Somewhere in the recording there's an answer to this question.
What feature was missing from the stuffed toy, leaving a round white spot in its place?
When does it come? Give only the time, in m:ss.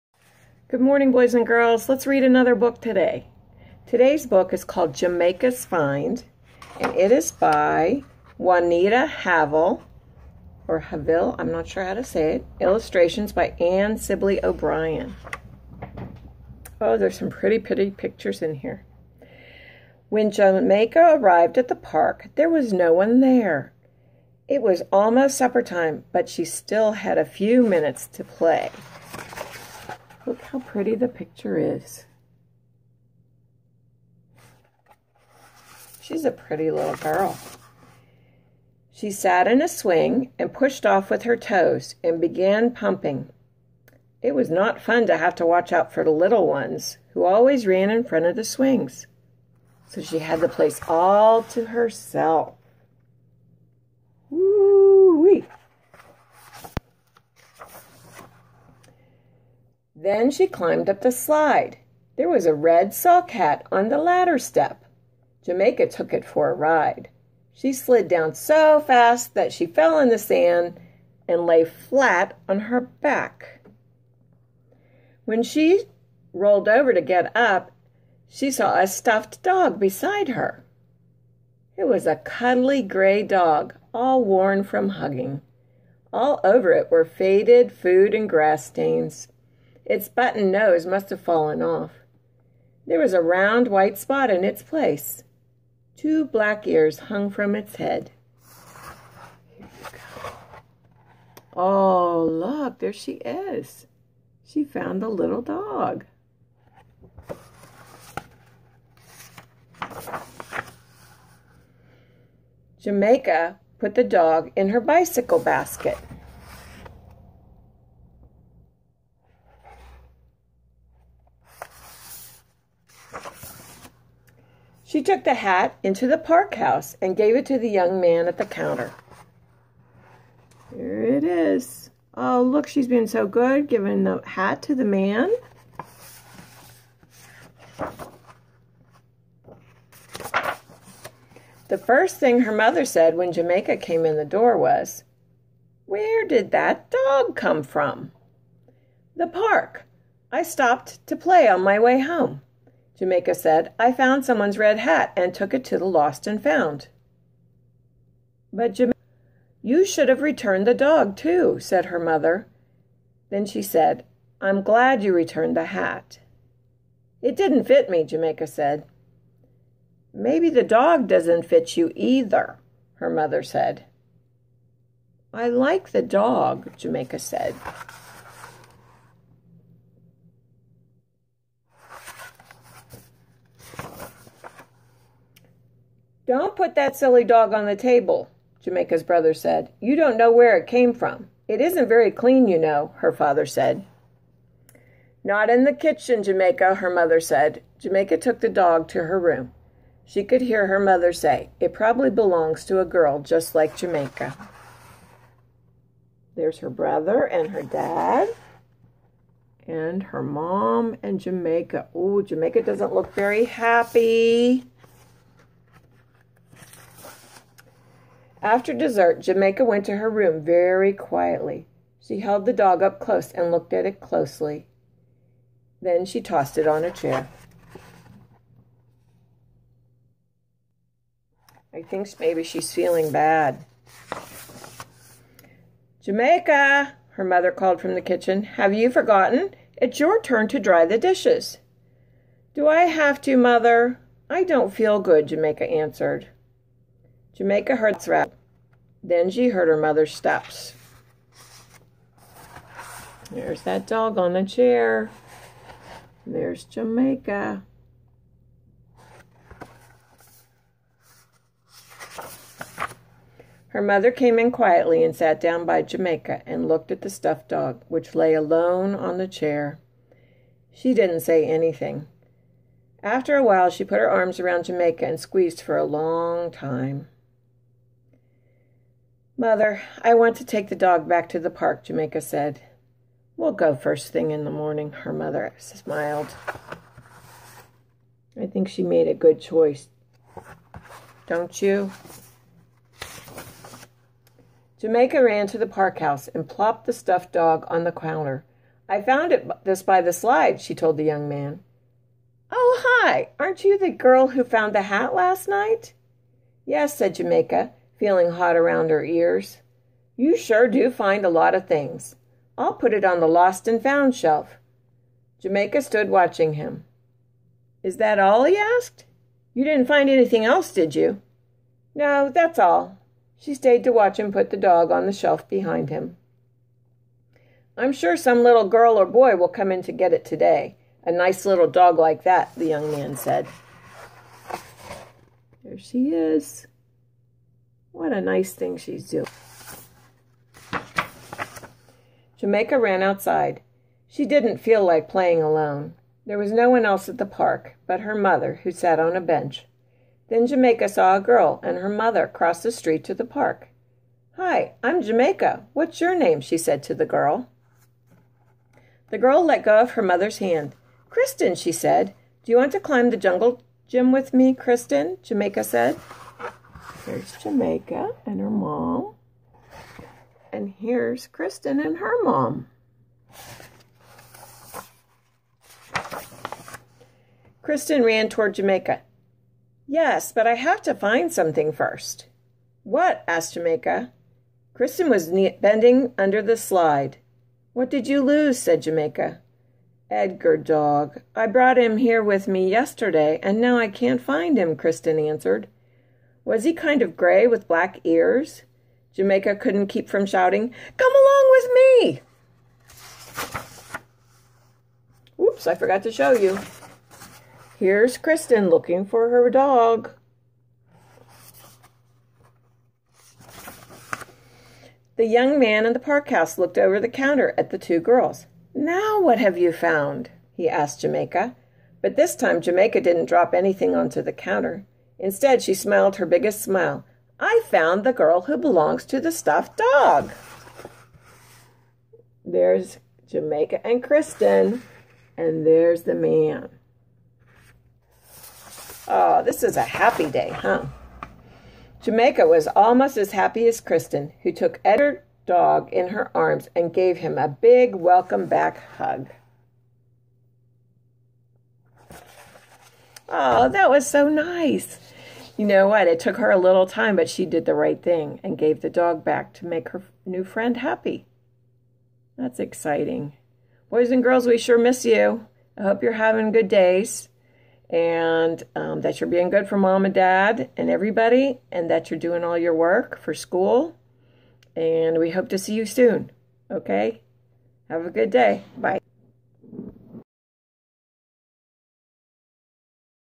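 1:30.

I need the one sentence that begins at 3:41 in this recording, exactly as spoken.
She held the dog up close and looked at it closely.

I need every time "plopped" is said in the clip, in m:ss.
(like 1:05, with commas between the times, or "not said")
4:56.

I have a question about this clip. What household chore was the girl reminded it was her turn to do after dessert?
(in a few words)
Dry the dishes.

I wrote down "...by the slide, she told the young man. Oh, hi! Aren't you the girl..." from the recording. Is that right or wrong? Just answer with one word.
right.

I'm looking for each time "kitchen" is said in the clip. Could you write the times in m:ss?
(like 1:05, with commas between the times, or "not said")
3:15, 3:58.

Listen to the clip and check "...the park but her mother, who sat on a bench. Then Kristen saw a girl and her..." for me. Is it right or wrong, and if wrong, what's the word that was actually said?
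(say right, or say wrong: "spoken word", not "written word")
wrong: "Jamaica", not "Kristen".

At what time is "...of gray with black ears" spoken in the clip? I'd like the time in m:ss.
6:37.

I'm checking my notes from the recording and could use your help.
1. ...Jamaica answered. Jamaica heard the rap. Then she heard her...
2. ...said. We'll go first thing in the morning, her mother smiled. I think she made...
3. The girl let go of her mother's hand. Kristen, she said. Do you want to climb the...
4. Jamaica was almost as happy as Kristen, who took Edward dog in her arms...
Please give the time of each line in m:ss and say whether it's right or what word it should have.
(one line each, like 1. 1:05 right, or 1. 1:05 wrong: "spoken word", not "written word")
1. 4:05 right
2. 4:42 right
3. 5:59 right
4. 7:22 right.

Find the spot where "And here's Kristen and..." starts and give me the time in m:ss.
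6:10.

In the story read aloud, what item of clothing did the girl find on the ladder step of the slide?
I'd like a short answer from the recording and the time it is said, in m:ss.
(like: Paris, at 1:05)
Red sock hat, at 1:02.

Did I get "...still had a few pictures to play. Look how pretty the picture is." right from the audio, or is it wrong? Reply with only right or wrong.
wrong.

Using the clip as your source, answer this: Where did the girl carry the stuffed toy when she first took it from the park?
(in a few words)
Bicycle basket.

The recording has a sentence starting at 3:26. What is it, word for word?
There's her brother and her dad and her mom and Jamaica.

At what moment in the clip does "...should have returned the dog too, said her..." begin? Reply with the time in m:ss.
2:39.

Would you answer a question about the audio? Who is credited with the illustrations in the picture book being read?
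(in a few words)
Anne Sibley O'Brien.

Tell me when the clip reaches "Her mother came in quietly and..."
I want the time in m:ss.
4:23.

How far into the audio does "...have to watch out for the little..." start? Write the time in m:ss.
0:45.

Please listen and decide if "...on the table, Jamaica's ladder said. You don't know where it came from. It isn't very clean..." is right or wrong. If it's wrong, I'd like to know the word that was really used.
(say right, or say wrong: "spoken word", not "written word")
wrong: "brother", not "ladder".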